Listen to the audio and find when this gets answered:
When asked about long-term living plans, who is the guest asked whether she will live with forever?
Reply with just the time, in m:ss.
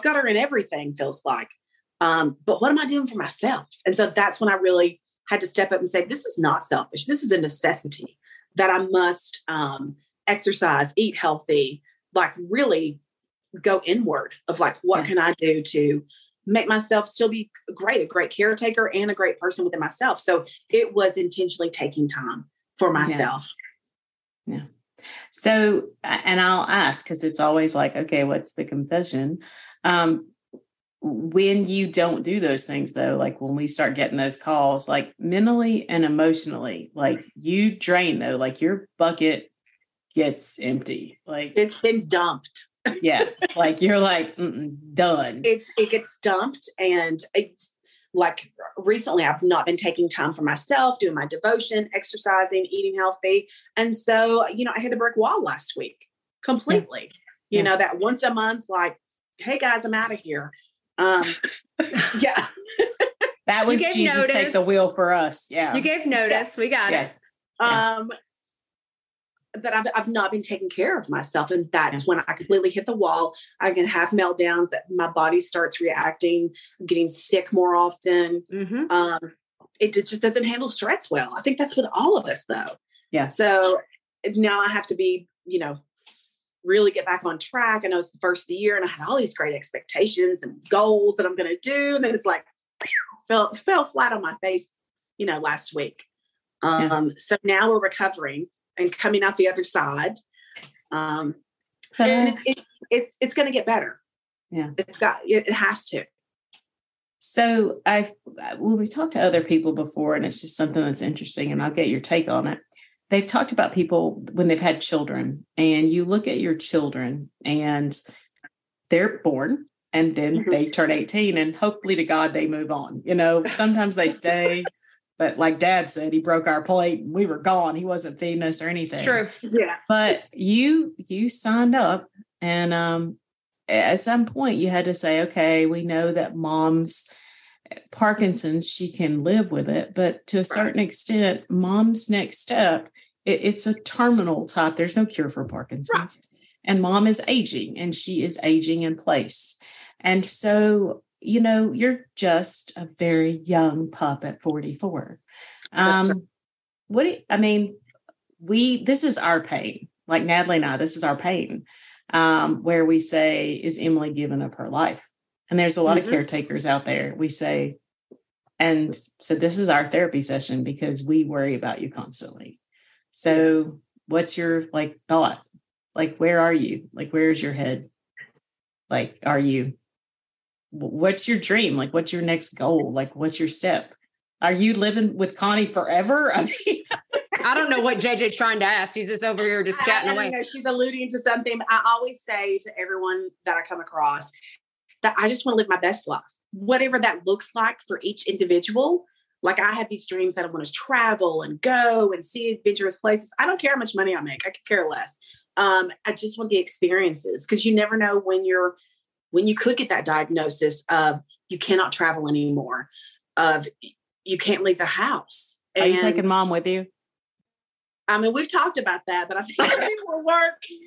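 3:05.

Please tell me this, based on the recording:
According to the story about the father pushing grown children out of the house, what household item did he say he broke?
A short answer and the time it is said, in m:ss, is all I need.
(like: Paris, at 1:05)
Plate, at 2:06.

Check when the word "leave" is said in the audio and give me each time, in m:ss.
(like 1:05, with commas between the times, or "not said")
3:34.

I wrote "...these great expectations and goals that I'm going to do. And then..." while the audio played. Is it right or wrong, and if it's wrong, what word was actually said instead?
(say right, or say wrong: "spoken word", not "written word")
right.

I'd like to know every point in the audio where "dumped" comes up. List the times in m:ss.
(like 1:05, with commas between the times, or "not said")
0:42, 0:46.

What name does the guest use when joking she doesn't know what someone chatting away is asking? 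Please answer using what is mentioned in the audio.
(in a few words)
JJ.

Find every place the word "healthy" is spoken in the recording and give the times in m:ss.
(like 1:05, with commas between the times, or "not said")
0:11, 0:52.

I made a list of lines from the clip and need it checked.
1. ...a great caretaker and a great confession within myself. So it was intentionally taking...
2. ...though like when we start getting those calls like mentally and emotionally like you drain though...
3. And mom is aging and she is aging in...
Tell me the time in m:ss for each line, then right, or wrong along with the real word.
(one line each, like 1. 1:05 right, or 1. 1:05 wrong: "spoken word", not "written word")
1. 0:18 wrong: "person", not "confession"
2. 0:32 right
3. 2:26 right.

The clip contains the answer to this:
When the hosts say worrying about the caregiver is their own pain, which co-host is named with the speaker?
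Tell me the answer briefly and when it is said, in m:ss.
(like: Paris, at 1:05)
Natalie, at 2:40.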